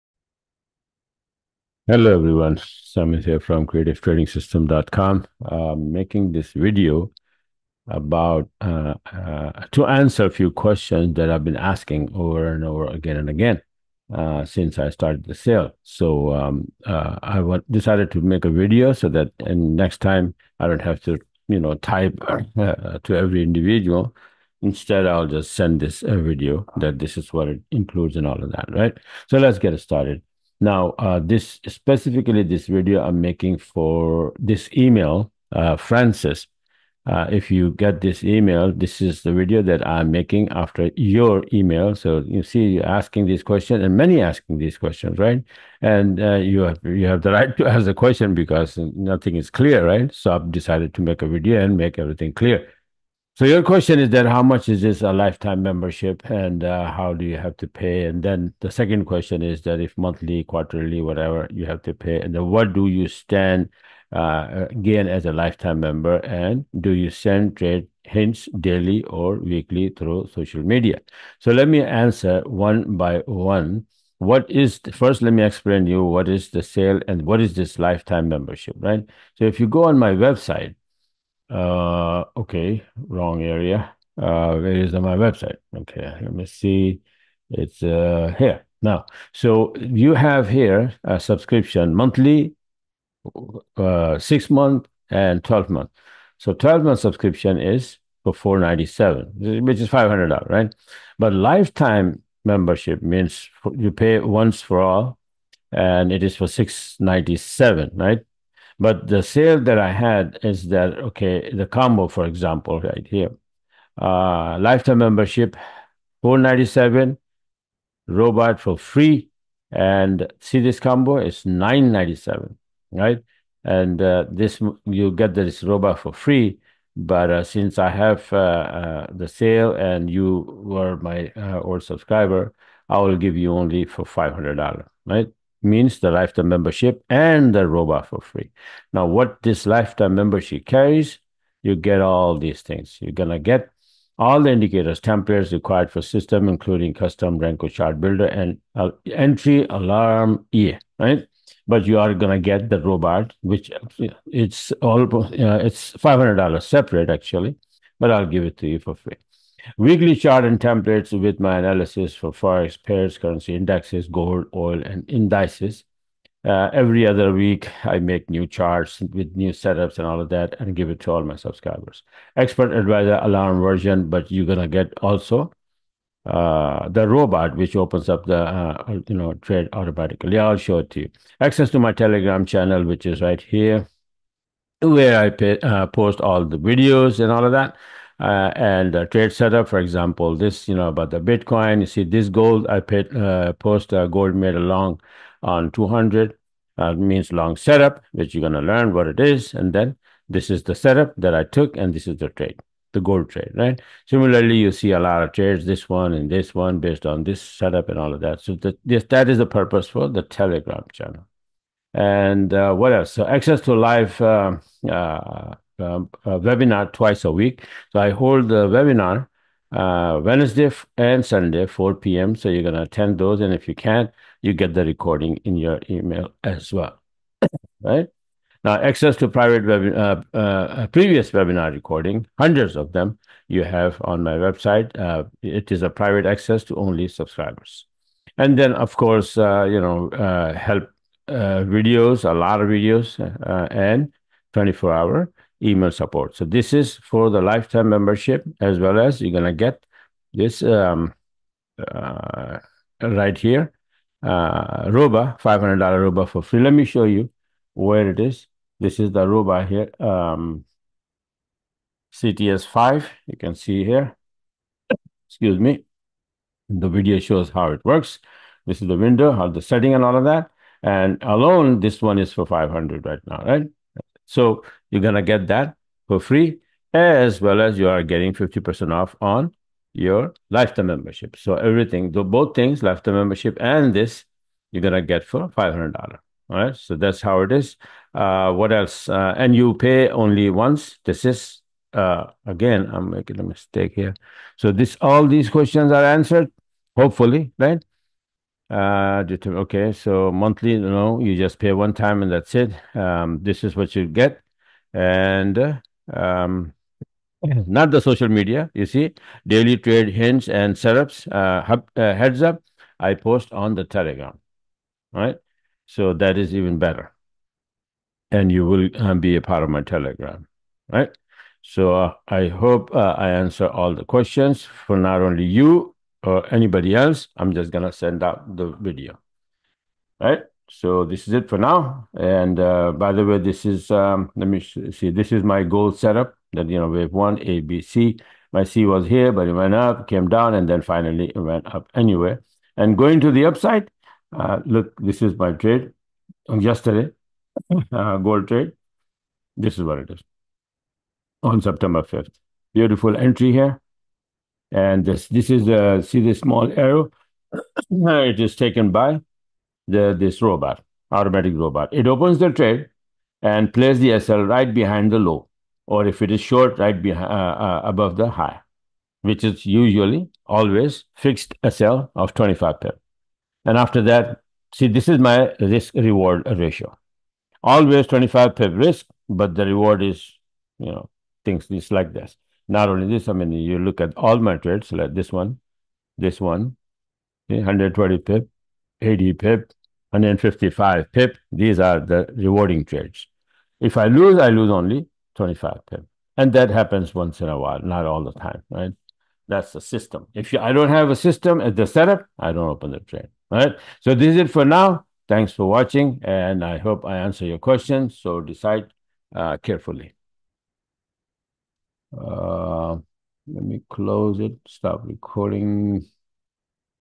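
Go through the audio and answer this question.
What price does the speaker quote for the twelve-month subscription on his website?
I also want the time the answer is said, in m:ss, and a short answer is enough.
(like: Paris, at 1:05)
$497, at 1:38.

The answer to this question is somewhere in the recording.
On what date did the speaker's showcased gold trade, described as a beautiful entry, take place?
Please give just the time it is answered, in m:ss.
5:51.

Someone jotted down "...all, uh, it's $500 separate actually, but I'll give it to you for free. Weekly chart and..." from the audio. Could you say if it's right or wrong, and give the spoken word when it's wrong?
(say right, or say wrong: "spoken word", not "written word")
right.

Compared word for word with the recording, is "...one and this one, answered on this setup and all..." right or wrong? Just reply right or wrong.
wrong.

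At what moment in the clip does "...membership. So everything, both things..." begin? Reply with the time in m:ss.
4:40.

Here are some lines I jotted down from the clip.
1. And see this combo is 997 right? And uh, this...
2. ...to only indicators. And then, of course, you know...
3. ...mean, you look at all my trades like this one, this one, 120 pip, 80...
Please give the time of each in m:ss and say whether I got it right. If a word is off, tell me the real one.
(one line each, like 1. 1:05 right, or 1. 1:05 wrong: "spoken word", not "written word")
1. 1:59 right
2. 3:56 wrong: "subscribers", not "indicators"
3. 6:23 right.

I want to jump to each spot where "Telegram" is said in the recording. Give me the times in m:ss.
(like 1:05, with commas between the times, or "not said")
3:01, 3:30, 5:13, 5:19.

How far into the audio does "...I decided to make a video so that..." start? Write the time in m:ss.
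0:17.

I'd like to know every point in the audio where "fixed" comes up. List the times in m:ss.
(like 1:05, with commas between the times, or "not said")
6:11.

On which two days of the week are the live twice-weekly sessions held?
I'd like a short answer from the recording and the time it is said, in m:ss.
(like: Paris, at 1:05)
Wednesday and Sunday, at 3:40.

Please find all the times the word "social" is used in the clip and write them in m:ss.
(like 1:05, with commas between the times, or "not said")
1:10, 5:08.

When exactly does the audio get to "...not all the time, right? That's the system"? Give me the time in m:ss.
6:37.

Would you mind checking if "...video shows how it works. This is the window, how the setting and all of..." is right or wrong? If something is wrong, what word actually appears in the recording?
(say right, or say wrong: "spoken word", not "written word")
right.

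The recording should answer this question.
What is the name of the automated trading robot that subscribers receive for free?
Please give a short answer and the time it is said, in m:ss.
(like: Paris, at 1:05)
CTS5, at 4:22.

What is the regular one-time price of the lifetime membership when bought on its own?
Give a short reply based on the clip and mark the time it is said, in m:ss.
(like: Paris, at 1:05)
$697, at 1:46.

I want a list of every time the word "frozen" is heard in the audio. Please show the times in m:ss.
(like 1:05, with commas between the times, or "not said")
not said.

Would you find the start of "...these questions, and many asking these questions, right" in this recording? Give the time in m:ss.
0:43.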